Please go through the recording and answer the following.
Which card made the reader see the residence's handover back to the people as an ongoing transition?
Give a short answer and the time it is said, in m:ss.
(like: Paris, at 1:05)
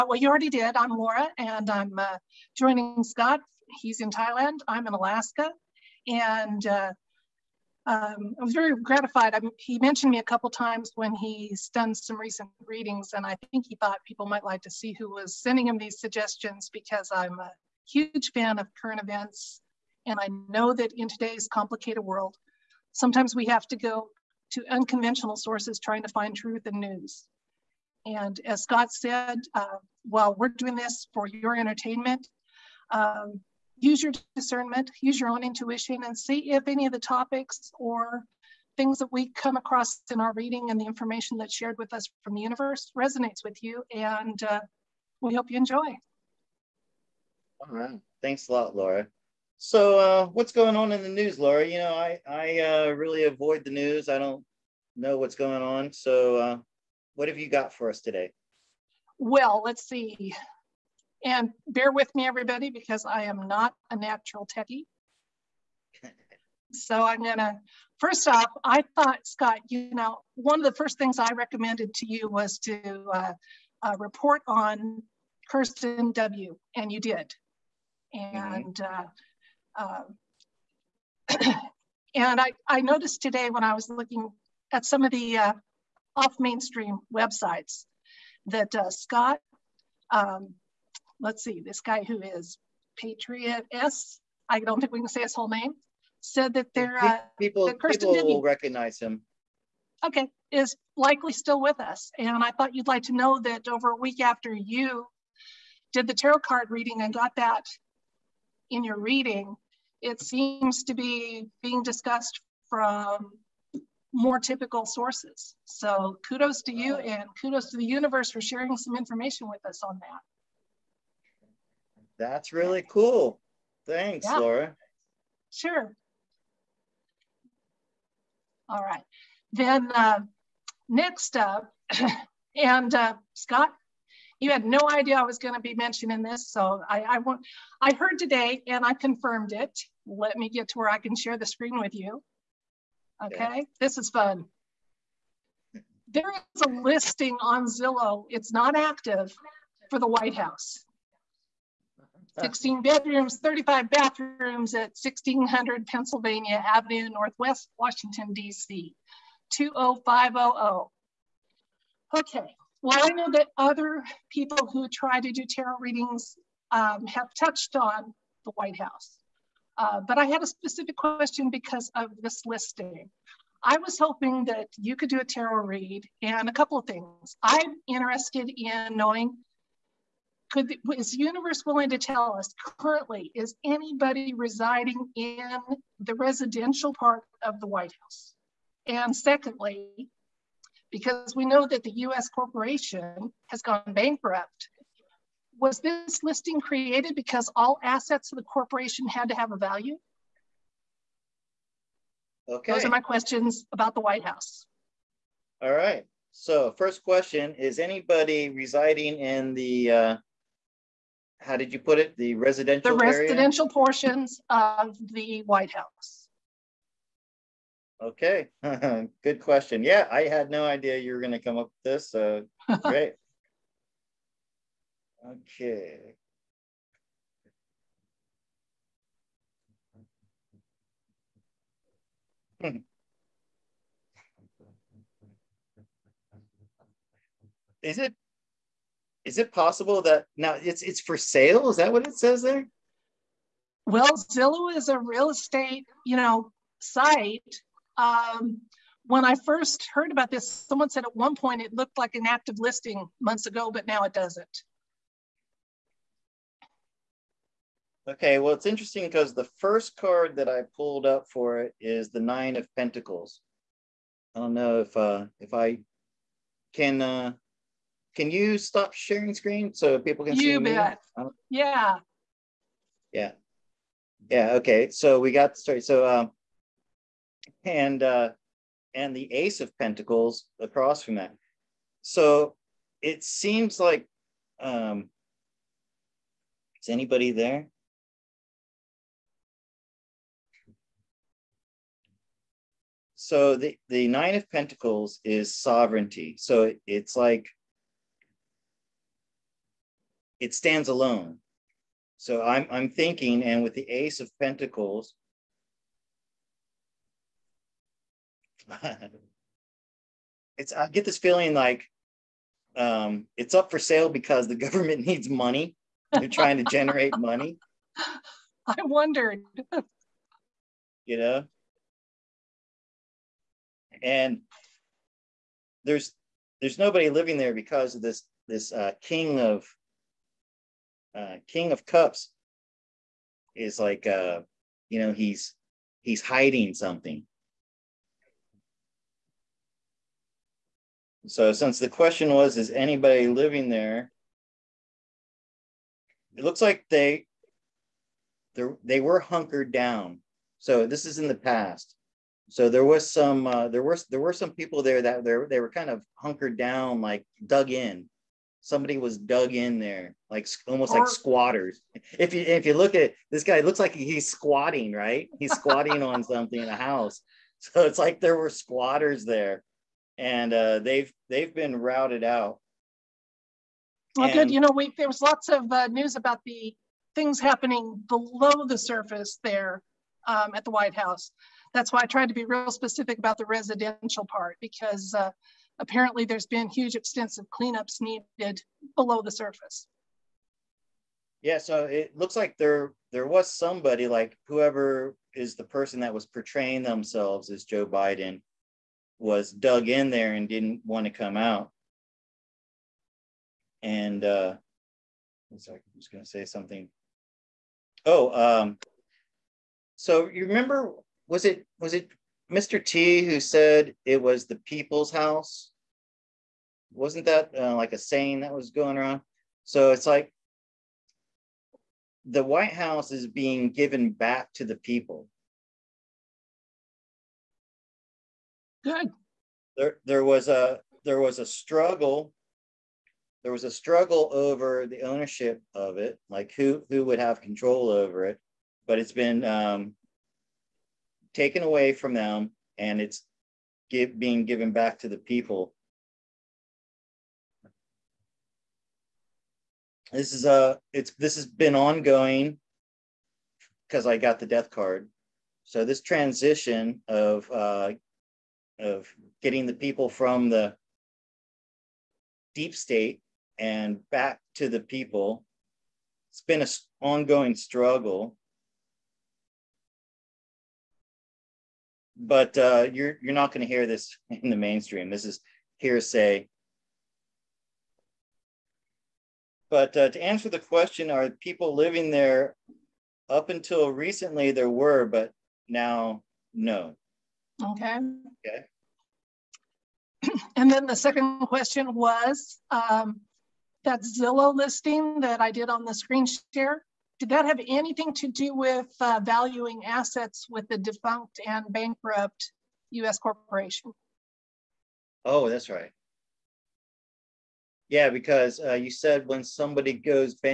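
Death card, at 7:34.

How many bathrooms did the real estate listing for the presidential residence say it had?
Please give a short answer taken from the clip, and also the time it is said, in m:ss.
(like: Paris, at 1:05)
35, at 2:33.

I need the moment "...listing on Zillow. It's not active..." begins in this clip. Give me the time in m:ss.
2:26.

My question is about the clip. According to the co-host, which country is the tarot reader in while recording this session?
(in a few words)
Thailand.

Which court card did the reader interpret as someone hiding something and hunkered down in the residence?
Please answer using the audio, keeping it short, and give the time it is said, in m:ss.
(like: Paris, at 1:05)
King of Cups, at 5:31.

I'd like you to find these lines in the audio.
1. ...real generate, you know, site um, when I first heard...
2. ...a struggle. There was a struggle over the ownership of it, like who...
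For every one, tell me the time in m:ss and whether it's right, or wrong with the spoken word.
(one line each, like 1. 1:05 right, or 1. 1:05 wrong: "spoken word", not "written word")
1. 4:04 wrong: "estate", not "generate"
2. 7:11 right.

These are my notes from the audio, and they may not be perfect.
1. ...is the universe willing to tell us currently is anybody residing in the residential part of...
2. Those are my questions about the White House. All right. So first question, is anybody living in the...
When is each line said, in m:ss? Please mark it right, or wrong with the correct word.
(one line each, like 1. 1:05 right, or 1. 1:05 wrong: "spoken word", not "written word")
1. 3:00 right
2. 3:22 wrong: "residing", not "living".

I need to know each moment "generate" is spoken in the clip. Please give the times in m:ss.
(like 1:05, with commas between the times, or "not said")
5:16.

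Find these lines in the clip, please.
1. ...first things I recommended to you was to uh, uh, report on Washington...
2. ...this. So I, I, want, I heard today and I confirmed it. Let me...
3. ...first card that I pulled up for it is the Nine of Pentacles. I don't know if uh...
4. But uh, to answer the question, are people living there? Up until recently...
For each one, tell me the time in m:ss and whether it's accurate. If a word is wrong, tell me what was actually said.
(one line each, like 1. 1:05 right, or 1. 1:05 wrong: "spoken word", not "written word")
1. 1:10 wrong: "Cirsten", not "Washington"
2. 2:16 right
3. 4:19 right
4. 7:59 right.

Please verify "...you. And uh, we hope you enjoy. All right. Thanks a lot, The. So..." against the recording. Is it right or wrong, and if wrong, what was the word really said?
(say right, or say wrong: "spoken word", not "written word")
wrong: "Laura", not "The".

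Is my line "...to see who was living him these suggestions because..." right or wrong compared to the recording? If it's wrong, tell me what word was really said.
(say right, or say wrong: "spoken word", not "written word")
wrong: "sending", not "living".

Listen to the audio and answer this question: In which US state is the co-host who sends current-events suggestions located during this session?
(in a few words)
Alaska.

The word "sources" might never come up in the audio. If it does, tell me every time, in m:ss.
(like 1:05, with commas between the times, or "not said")
0:25, 1:54.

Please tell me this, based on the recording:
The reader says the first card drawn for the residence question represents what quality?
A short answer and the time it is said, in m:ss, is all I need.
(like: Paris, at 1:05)
Sovereignty, at 4:55.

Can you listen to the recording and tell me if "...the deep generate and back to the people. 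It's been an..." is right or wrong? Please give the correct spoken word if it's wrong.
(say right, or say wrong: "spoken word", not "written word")
wrong: "state", not "generate".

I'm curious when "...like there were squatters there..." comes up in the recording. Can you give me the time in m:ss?
6:07.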